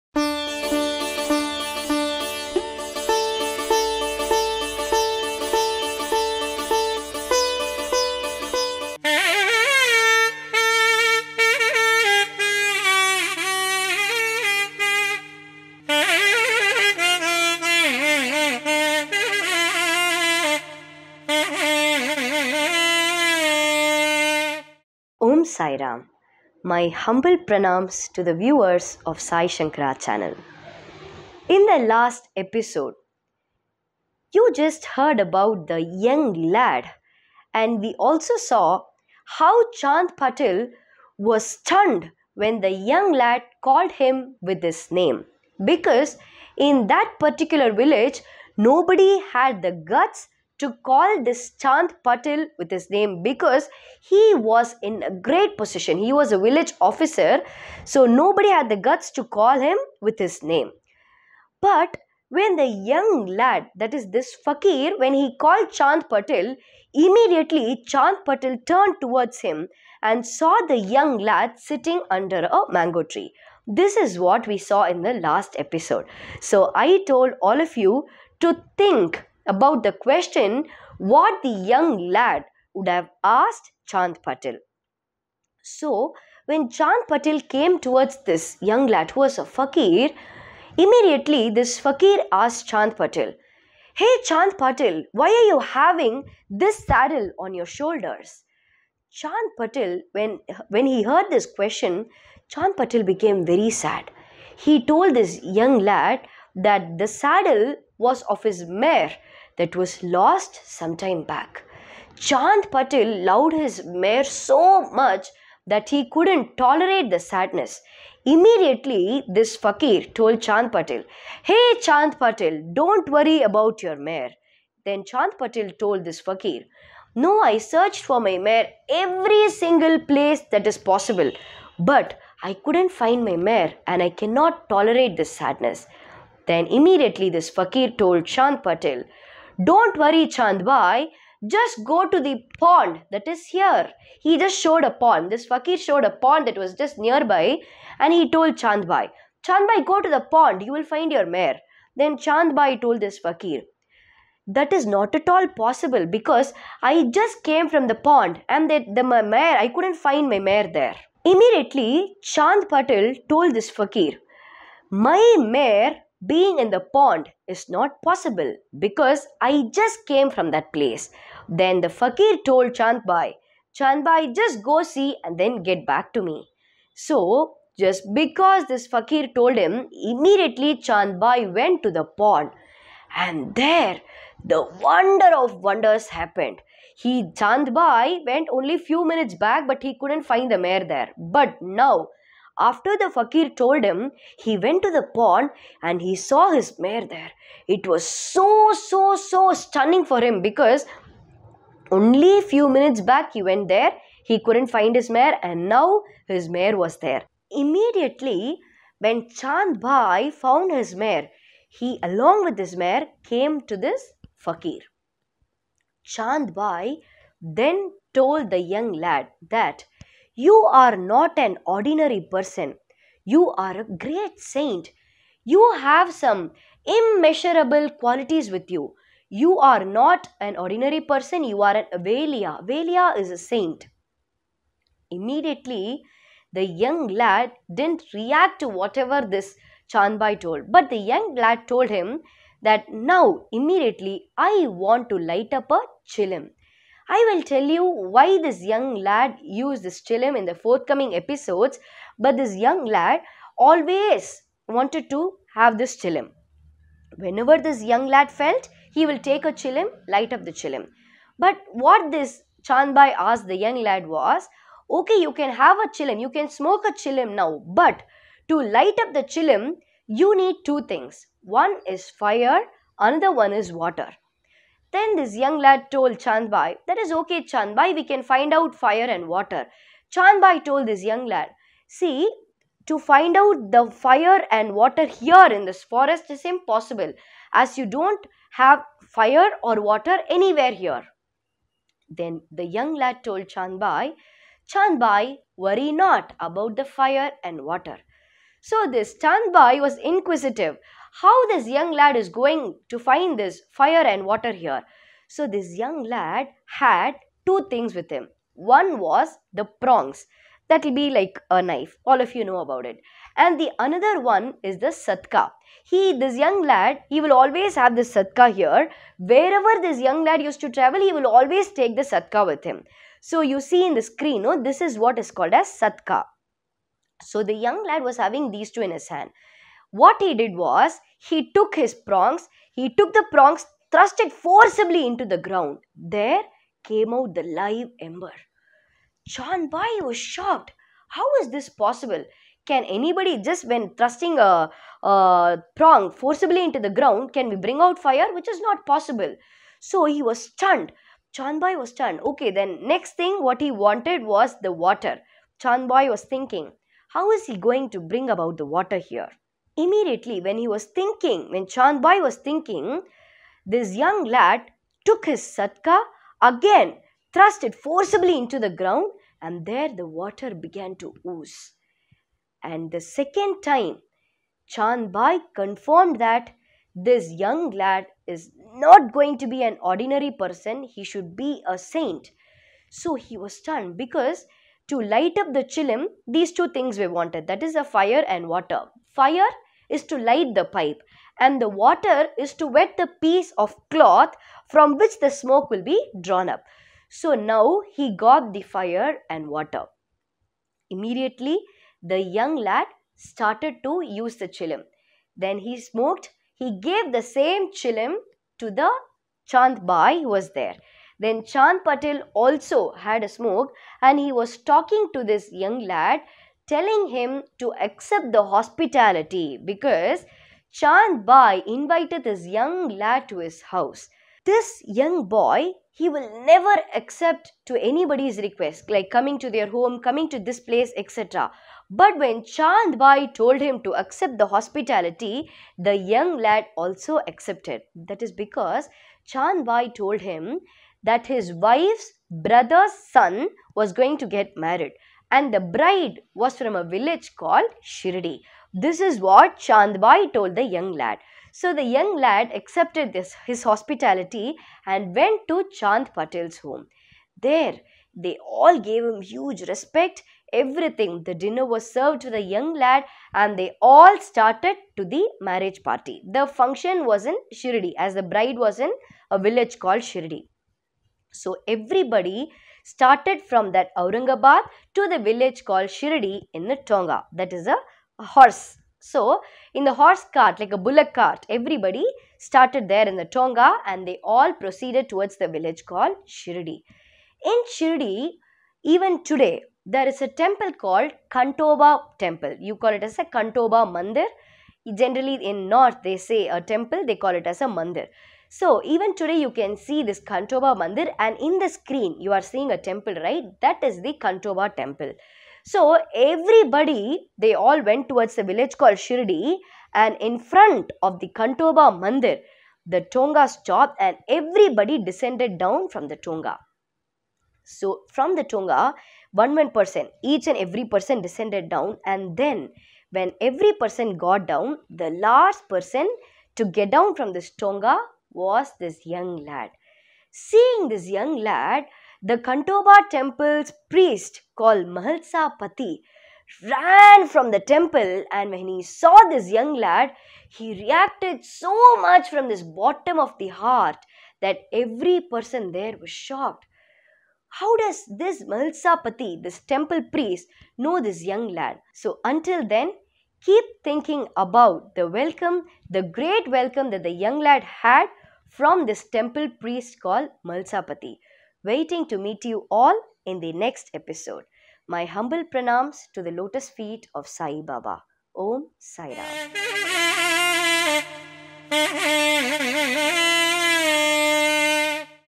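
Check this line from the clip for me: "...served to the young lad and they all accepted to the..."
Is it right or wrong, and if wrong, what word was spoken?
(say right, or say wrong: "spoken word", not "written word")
wrong: "started", not "accepted".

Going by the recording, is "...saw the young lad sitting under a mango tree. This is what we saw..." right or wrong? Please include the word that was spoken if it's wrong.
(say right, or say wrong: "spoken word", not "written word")
right.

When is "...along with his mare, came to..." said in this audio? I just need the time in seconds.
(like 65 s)
212 s.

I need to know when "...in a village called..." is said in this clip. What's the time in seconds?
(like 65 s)
468 s.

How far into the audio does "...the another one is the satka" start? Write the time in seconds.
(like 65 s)
313 s.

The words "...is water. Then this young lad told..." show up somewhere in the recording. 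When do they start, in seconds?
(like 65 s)
273 s.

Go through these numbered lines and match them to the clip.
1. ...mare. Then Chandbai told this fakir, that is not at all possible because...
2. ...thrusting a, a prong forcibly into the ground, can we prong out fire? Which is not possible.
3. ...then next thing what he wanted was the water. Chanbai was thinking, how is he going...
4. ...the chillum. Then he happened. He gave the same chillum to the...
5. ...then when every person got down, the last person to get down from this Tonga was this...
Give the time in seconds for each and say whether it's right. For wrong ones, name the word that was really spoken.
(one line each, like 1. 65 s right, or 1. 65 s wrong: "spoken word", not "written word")
1. 151 s right
2. 343 s wrong: "bring", not "prong"
3. 352 s right
4. 404 s wrong: "smoked", not "happened"
5. 522 s right.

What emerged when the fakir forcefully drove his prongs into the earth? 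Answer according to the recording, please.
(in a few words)
Live ember.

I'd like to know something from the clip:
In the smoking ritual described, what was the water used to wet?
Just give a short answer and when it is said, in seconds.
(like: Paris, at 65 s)
Piece of cloth, at 393 s.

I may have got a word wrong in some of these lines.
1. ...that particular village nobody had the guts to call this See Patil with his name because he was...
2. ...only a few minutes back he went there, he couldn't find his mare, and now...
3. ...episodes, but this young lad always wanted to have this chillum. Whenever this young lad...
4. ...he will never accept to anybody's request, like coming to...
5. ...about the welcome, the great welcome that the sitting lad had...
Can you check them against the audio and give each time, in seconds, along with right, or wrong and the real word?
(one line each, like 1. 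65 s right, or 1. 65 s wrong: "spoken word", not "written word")
1. 46 s wrong: "Chand", not "See"
2. 201 s right
3. 251 s right
4. 425 s right
5. 554 s wrong: "young", not "sitting".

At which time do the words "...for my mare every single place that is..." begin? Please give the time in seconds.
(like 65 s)
128 s.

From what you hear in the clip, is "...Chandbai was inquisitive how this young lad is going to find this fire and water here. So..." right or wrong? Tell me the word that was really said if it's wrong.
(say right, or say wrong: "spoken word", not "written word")
right.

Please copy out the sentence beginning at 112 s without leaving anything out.
Chand Patil loved his mare so much that he couldn't tolerate the sadness.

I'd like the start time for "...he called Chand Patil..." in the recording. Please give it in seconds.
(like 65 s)
65 s.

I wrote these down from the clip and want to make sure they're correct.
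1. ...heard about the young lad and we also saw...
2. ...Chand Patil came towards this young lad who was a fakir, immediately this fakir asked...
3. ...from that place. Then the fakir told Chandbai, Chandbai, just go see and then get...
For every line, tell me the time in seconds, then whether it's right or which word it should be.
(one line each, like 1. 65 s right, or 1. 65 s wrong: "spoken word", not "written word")
1. 34 s right
2. 86 s right
3. 170 s right.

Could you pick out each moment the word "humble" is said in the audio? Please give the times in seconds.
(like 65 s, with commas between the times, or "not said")
27 s, 565 s.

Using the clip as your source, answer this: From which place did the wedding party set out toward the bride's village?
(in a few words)
Aurangabad.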